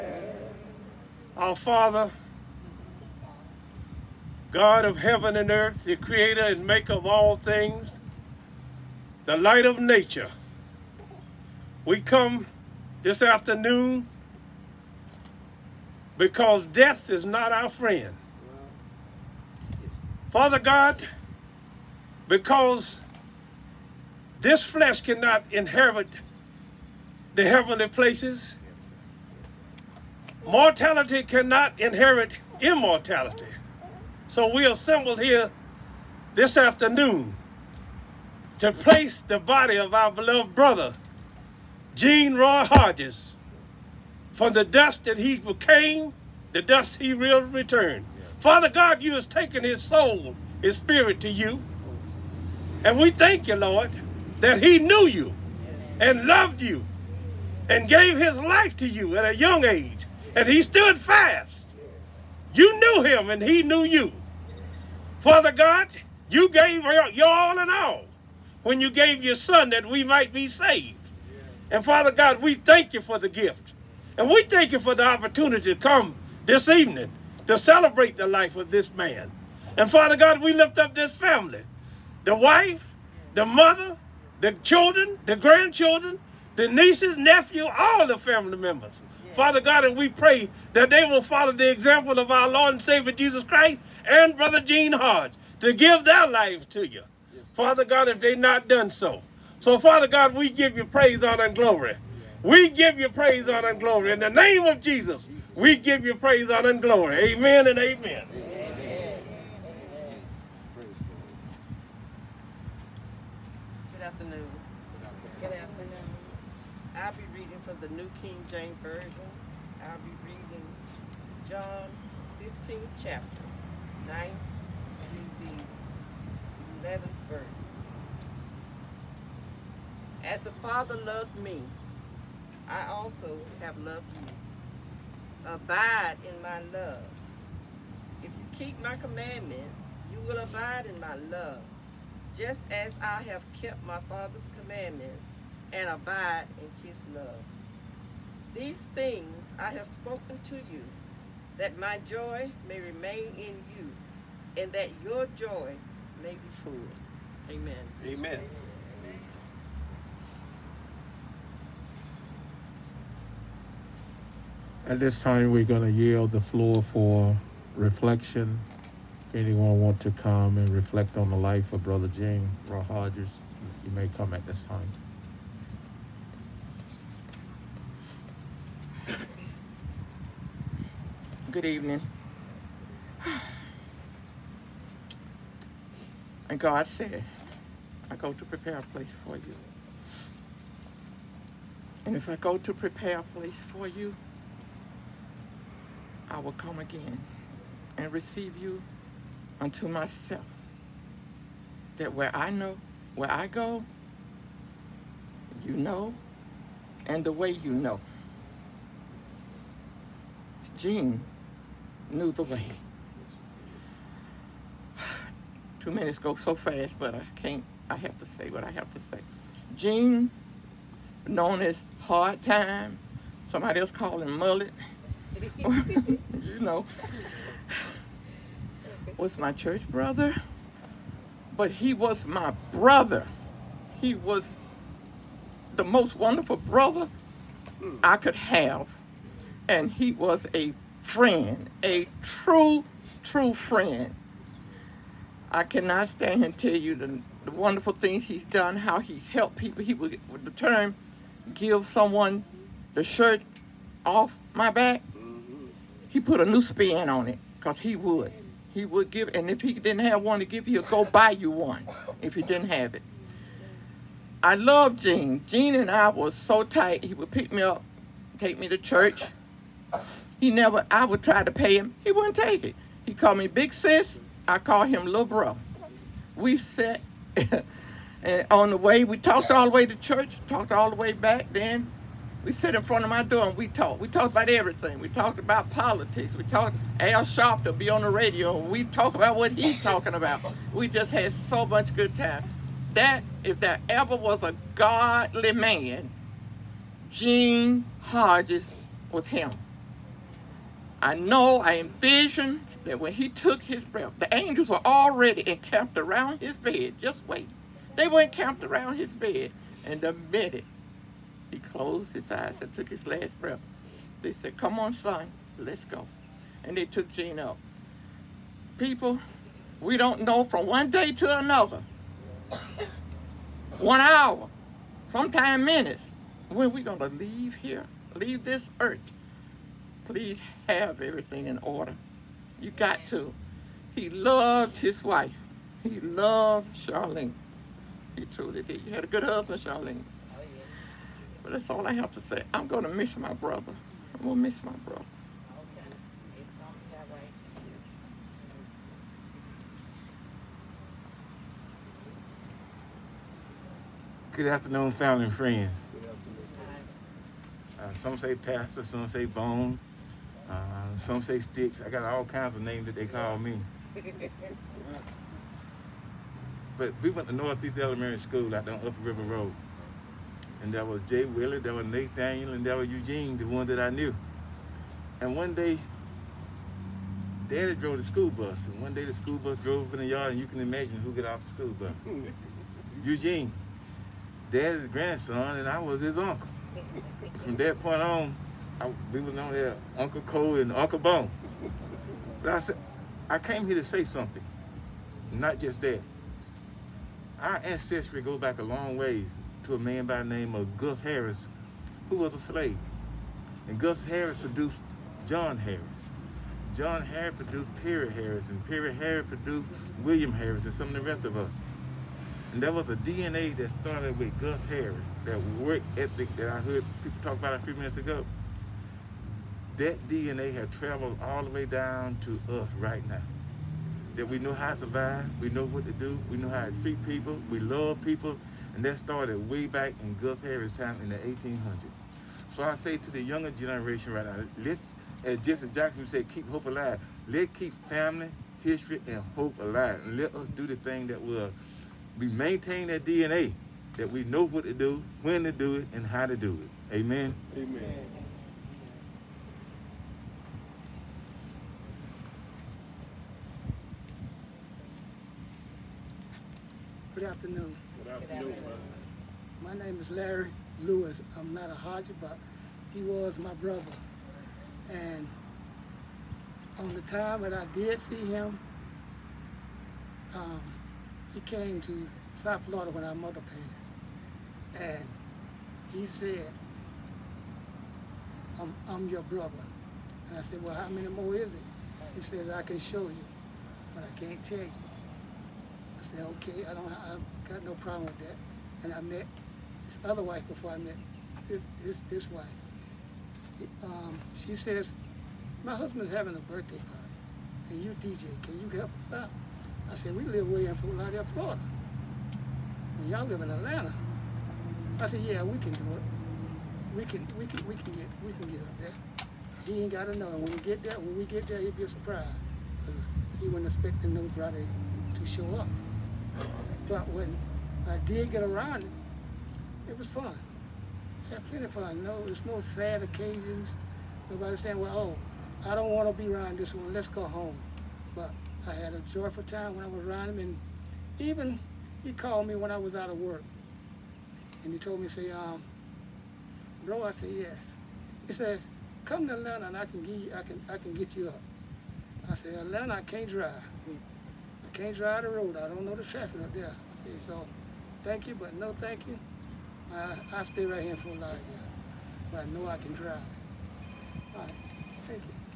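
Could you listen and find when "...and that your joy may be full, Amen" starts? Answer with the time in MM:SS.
02:34.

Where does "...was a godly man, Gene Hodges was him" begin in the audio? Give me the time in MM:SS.
04:54.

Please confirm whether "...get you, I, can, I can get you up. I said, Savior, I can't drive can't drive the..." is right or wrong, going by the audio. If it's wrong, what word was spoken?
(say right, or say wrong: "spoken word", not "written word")
wrong: "Atlanta", not "Savior".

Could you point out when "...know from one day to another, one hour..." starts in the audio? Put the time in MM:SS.
05:20.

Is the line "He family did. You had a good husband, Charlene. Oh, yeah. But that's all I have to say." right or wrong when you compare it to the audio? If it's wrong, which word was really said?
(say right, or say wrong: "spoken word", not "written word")
wrong: "truly", not "family".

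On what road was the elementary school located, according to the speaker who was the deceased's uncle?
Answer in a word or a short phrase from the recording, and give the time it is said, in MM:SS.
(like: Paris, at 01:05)
Upper River Road, at 06:08.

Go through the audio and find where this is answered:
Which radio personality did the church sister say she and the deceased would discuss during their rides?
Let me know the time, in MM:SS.
04:46.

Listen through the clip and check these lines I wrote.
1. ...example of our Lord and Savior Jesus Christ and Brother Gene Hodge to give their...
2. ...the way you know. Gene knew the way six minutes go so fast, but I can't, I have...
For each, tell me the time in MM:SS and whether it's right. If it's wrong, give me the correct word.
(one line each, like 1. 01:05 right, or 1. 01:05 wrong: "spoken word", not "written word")
1. 01:31 right
2. 03:27 wrong: "two", not "six".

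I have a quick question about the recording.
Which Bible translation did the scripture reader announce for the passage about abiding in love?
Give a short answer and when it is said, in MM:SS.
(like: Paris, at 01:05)
New King James Version, at 01:57.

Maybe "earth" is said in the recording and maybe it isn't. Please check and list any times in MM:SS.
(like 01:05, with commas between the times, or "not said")
00:05, 05:28.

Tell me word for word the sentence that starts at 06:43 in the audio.
And Gus Harris produced John Harris.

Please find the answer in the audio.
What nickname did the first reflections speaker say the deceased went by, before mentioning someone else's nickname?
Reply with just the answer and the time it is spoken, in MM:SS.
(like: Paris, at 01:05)
Hard Time, at 03:42.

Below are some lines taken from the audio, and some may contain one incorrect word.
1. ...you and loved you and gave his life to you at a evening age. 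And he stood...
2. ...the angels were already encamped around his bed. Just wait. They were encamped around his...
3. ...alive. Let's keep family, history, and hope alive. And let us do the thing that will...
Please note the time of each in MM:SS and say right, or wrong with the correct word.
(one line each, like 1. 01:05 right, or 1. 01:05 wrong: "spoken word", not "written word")
1. 00:55 wrong: "young", not "evening"
2. 05:04 right
3. 07:16 right.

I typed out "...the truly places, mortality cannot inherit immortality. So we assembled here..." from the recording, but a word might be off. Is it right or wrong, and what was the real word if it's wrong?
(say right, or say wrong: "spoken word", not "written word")
wrong: "heavenly", not "truly".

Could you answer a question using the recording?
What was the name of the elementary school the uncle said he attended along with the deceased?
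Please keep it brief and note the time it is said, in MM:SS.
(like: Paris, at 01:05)
Northeast Elementary School, at 06:07.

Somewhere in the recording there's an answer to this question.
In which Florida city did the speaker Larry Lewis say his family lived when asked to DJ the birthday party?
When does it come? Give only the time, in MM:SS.
08:20.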